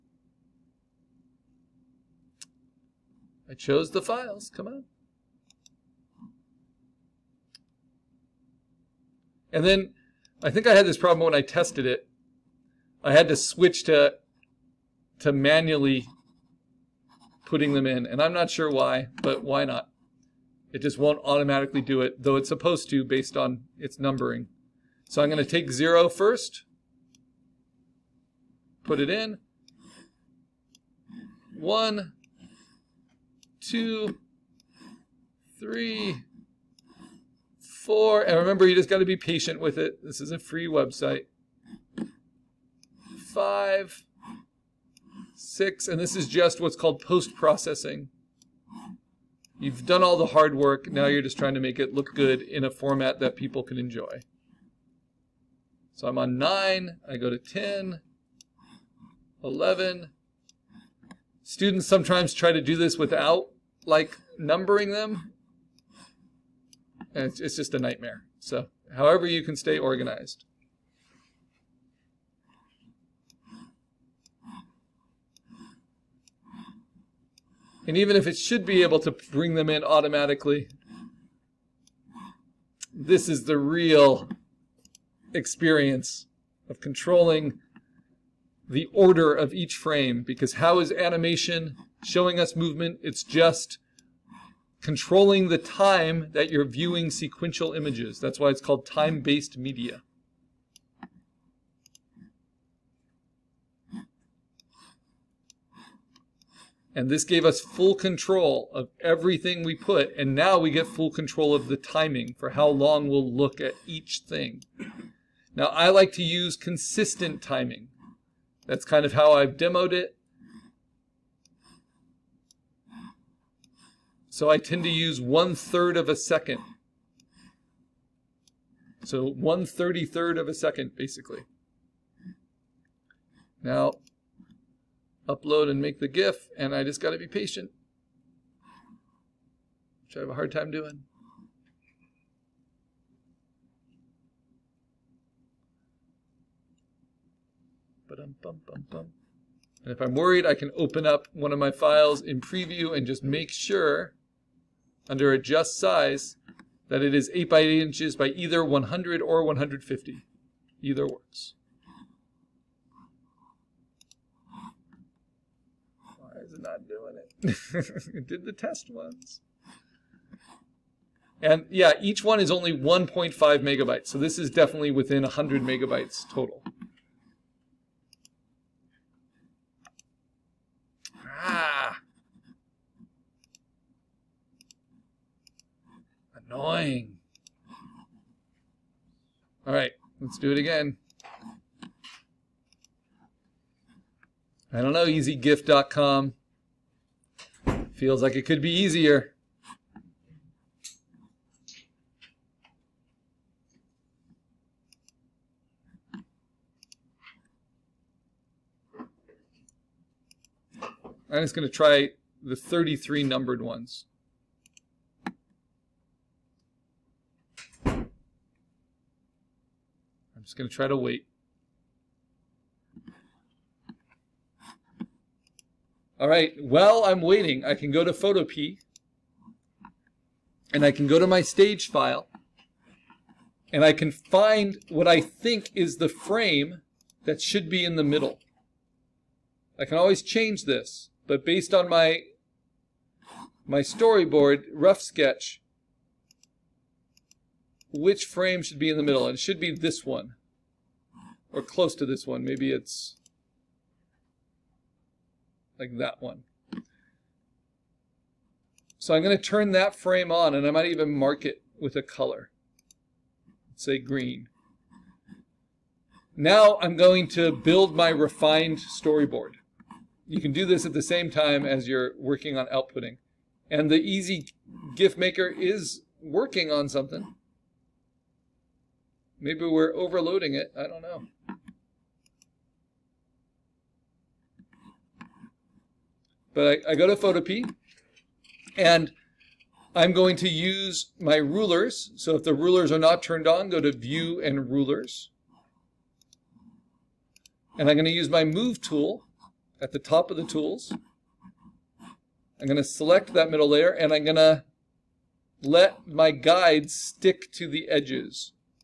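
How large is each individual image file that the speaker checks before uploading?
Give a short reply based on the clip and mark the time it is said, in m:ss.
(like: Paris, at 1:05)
1.5 megabytes, at 2:52.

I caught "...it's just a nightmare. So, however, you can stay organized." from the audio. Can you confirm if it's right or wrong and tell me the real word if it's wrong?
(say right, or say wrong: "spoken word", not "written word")
right.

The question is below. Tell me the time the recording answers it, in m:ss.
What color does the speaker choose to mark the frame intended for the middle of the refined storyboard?
4:23.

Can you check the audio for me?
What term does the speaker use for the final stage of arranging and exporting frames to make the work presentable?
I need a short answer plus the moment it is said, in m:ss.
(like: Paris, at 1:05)
post-processing, at 0:47.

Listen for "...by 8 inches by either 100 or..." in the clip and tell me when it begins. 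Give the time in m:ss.
2:37.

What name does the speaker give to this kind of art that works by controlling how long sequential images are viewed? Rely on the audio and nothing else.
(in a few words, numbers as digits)
time-based media.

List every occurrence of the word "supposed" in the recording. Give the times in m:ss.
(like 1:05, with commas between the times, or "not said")
0:22.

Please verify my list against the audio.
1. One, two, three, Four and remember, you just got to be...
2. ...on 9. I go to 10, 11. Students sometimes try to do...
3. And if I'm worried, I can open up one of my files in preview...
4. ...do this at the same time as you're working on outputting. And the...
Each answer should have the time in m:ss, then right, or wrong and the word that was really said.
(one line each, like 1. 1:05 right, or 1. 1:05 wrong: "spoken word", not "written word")
1. 0:31 right
2. 0:56 right
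3. 2:28 right
4. 4:30 right.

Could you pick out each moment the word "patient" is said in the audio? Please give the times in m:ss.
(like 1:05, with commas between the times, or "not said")
0:39, 2:17.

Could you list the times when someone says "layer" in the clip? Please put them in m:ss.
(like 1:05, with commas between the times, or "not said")
5:03.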